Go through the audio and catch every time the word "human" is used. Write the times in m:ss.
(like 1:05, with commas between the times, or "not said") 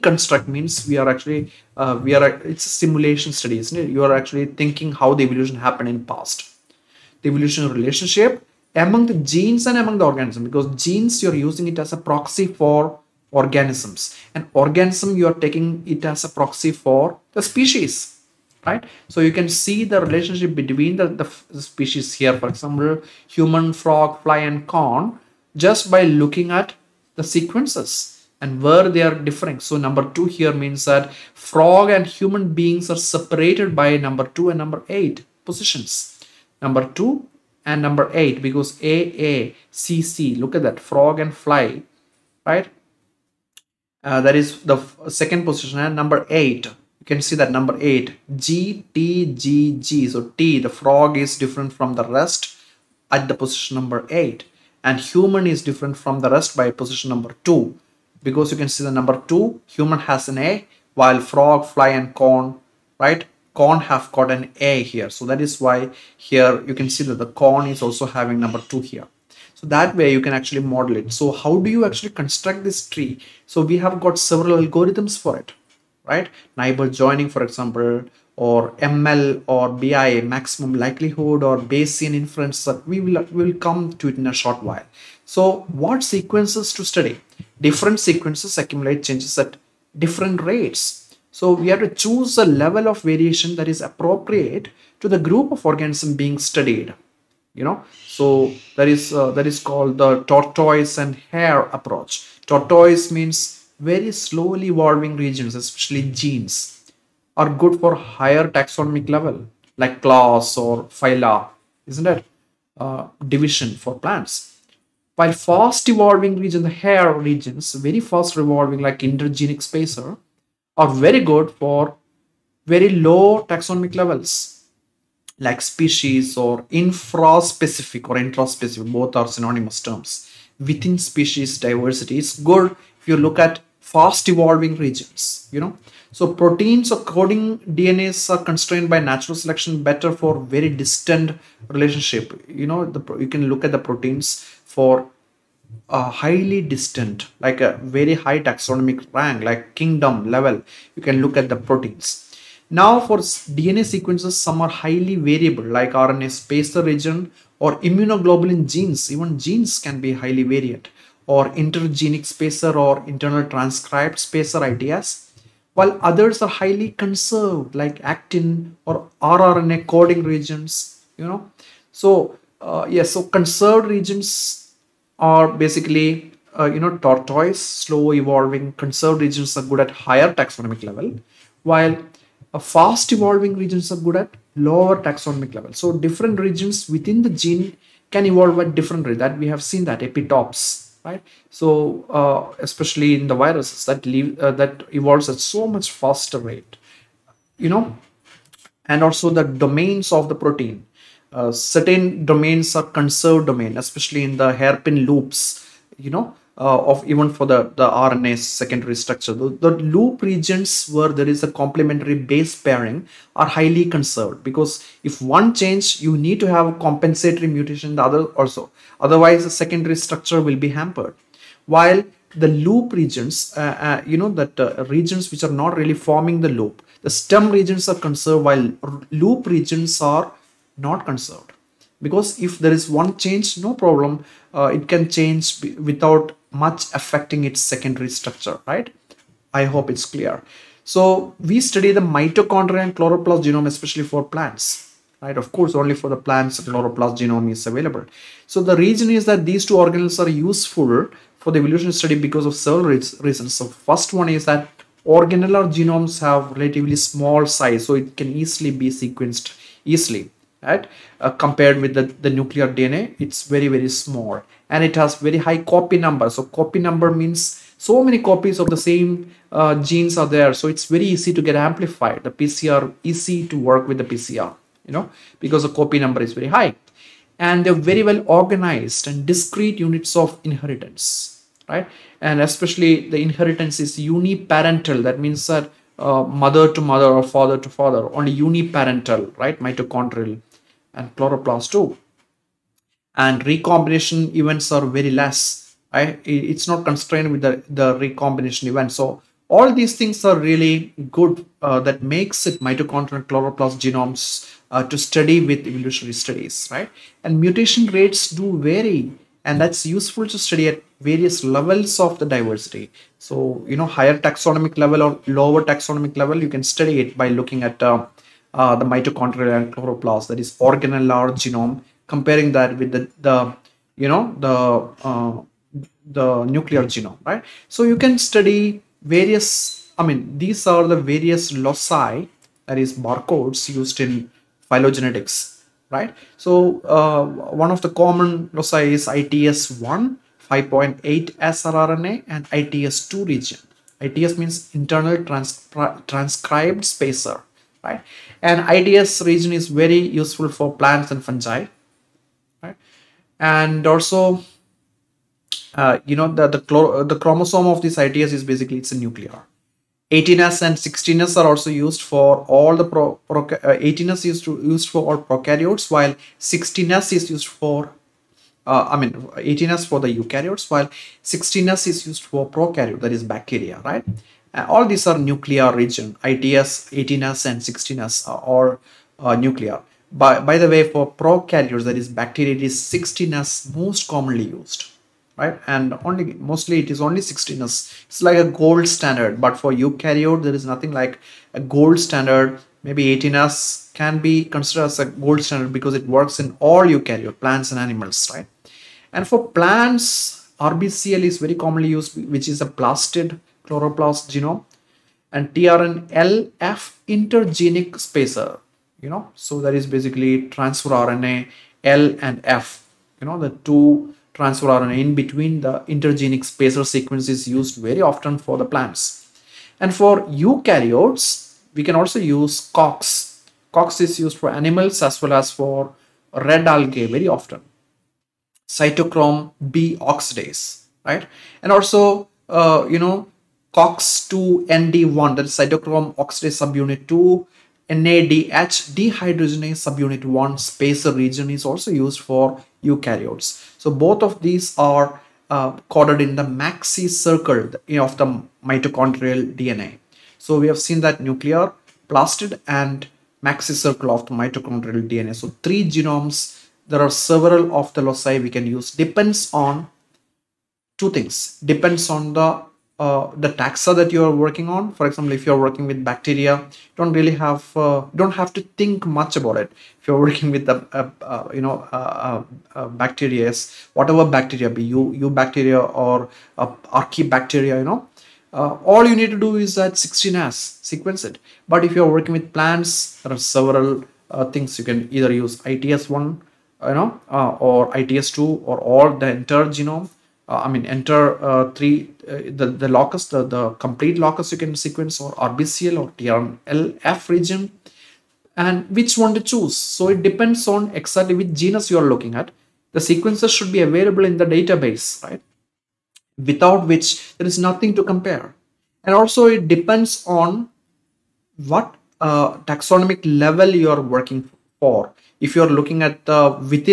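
0:23, 0:32, 0:54, 0:59.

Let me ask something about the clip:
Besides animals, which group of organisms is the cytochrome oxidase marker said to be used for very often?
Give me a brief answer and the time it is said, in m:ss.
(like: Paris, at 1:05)
red algae, at 7:06.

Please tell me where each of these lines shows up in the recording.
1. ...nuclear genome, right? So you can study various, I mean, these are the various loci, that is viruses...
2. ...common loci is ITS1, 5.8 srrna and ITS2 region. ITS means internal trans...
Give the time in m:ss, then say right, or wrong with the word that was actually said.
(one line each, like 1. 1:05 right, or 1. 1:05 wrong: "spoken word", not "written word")
1. 5:26 wrong: "barcodes", not "viruses"
2. 5:37 right.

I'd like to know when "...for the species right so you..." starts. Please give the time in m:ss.
0:16.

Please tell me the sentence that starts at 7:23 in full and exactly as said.
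So both of these are uh, coded in the maxi circle of the mitochondrial DNA.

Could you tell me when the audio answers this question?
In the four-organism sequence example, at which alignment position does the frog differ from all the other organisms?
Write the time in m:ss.
0:50.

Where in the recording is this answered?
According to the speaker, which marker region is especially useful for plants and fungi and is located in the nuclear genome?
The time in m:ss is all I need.
5:48.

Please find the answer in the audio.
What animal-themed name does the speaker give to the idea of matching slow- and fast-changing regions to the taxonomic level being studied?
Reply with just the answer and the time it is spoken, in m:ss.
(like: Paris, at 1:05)
tortoise and hare approach, at 1:40.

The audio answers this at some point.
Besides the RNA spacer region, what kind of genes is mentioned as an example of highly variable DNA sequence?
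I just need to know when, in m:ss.
2:37.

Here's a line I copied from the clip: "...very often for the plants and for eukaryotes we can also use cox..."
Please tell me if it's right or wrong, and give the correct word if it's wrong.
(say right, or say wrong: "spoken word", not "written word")
right.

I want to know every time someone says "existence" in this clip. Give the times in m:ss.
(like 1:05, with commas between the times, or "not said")
not said.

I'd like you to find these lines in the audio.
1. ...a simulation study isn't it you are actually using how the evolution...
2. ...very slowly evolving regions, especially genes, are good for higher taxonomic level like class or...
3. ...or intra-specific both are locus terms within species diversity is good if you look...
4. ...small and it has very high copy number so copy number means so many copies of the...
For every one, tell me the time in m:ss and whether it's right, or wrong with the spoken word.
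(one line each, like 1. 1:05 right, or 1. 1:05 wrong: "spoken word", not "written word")
1. 0:02 wrong: "thinking", not "using"
2. 1:43 right
3. 2:08 wrong: "synonymous", not "locus"
4. 4:23 right.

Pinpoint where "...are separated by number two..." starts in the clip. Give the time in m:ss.
0:32.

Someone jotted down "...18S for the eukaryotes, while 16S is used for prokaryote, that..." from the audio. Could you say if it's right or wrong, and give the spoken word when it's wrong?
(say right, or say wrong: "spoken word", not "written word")
right.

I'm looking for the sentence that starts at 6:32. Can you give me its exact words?
Maybe 18S can be considered as a gold standard because it works in all eukaryote plants and animals, right?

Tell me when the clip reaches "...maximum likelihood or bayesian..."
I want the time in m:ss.
1:20.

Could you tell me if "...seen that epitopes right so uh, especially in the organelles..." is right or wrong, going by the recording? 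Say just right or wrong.
wrong.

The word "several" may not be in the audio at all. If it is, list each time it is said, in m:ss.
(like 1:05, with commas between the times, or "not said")
1:14, 4:12, 7:37, 8:03.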